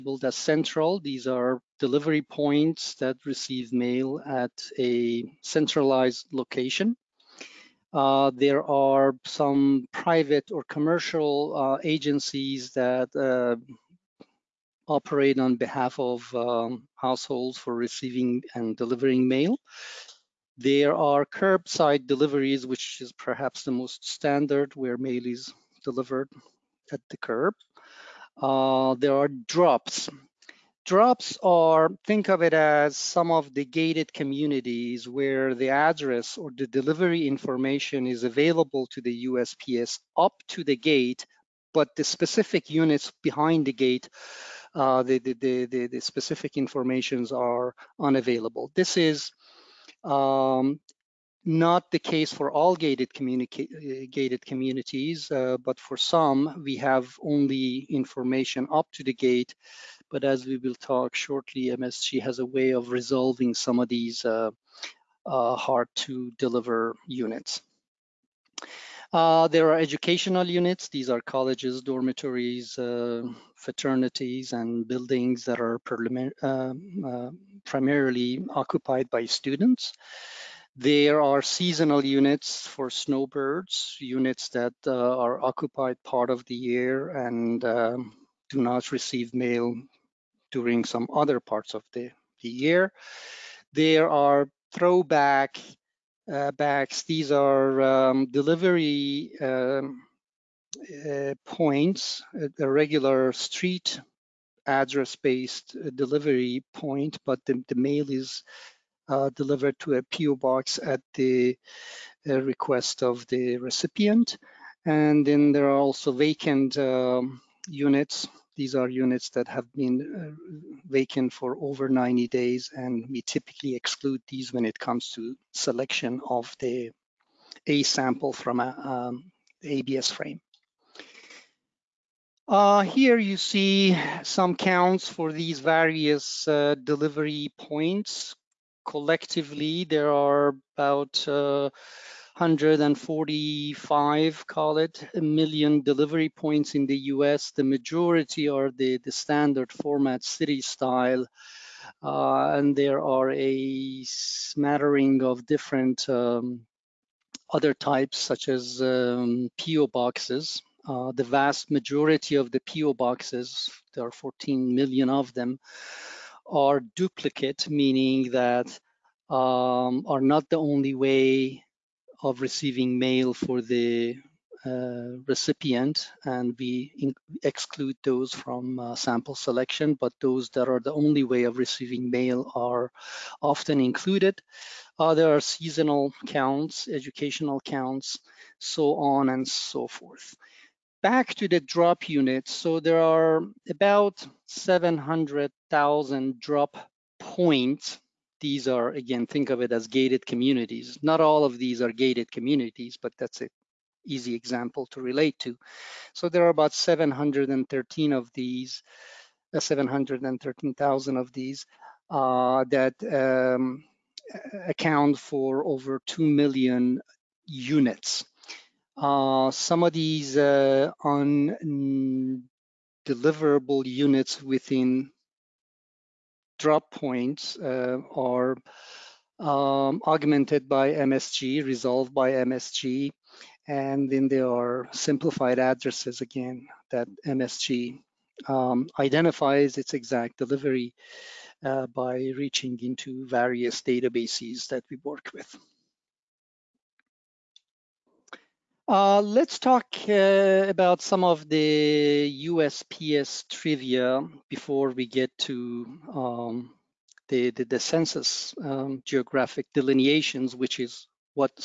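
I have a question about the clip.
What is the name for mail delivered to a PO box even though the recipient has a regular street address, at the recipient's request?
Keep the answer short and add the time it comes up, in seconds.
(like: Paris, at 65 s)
throwback, at 94 s.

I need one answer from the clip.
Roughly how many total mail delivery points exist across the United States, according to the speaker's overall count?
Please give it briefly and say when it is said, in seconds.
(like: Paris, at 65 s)
145 million, at 142 s.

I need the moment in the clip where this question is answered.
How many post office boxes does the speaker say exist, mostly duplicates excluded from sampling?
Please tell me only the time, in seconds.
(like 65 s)
164 s.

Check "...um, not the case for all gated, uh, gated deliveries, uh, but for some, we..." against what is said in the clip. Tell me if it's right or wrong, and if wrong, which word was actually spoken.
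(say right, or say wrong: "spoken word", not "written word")
wrong: "communities", not "deliveries".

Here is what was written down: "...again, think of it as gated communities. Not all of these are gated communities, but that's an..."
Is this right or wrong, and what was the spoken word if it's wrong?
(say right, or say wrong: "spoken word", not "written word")
right.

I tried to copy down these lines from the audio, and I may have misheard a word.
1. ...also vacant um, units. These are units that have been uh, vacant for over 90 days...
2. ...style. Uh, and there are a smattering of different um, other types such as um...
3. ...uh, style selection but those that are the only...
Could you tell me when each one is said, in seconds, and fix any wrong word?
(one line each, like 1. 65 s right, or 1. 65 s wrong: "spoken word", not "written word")
1. 115 s right
2. 150 s right
3. 178 s wrong: "sample", not "style".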